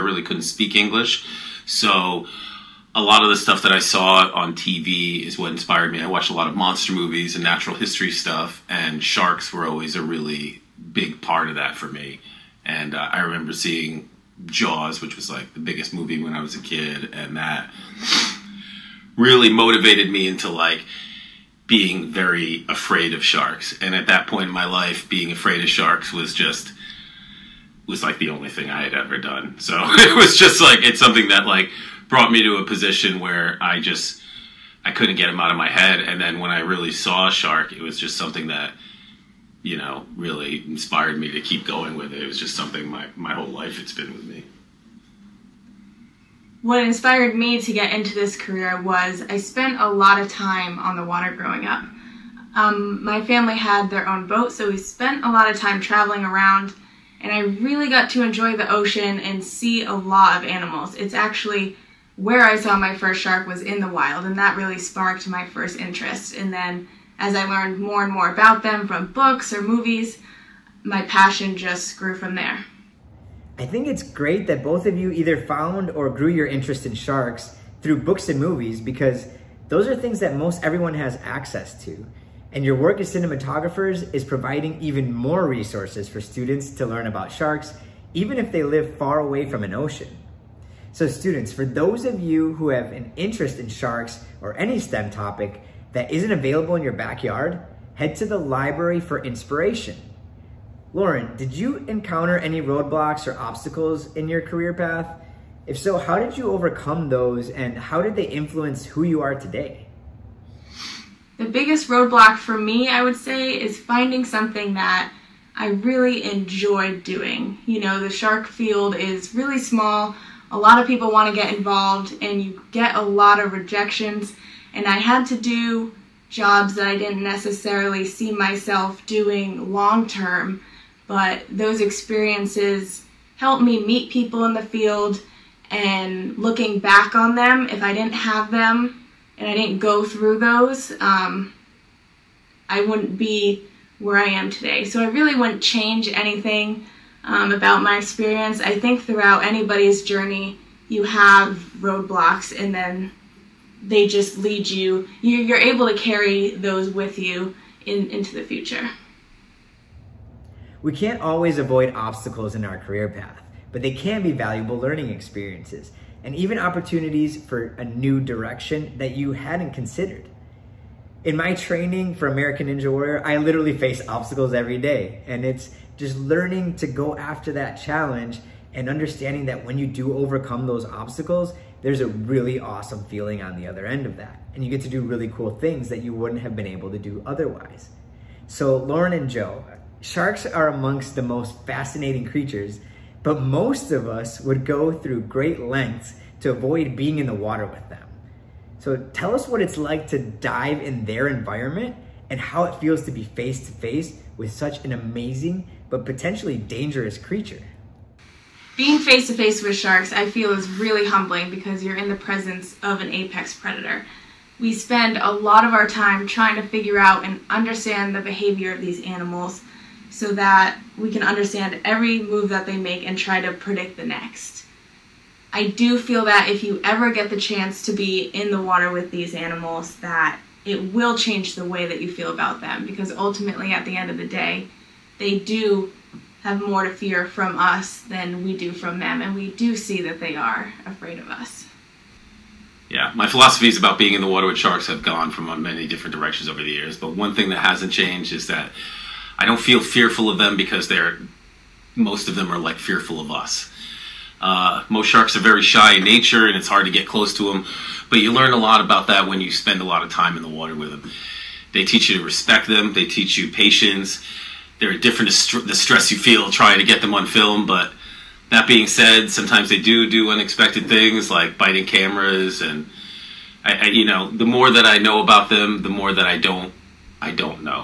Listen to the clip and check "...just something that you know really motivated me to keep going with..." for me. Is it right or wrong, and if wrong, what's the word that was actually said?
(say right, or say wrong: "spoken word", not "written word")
wrong: "inspired", not "motivated".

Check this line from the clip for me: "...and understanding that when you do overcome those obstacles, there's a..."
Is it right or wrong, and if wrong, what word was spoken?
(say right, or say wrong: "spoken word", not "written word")
right.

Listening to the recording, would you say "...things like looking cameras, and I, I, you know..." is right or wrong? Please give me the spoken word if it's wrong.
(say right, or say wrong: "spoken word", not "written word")
wrong: "biting", not "looking".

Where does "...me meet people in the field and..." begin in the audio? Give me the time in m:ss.
2:13.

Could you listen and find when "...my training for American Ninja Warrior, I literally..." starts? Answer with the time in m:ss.
2:51.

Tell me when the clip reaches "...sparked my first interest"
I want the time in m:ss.
1:04.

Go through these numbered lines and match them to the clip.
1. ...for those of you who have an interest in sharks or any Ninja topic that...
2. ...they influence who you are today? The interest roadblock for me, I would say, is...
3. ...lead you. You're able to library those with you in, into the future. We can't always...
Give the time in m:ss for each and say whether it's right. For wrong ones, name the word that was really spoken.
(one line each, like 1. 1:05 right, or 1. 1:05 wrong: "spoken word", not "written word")
1. 1:31 wrong: "STEM", not "Ninja"
2. 1:48 wrong: "biggest", not "interest"
3. 2:34 wrong: "carry", not "library".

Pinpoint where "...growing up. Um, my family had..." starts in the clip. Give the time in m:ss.
0:51.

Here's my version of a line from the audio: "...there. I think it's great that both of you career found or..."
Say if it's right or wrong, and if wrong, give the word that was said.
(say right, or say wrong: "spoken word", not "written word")
wrong: "either", not "career".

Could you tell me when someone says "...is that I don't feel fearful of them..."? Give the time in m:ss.
4:08.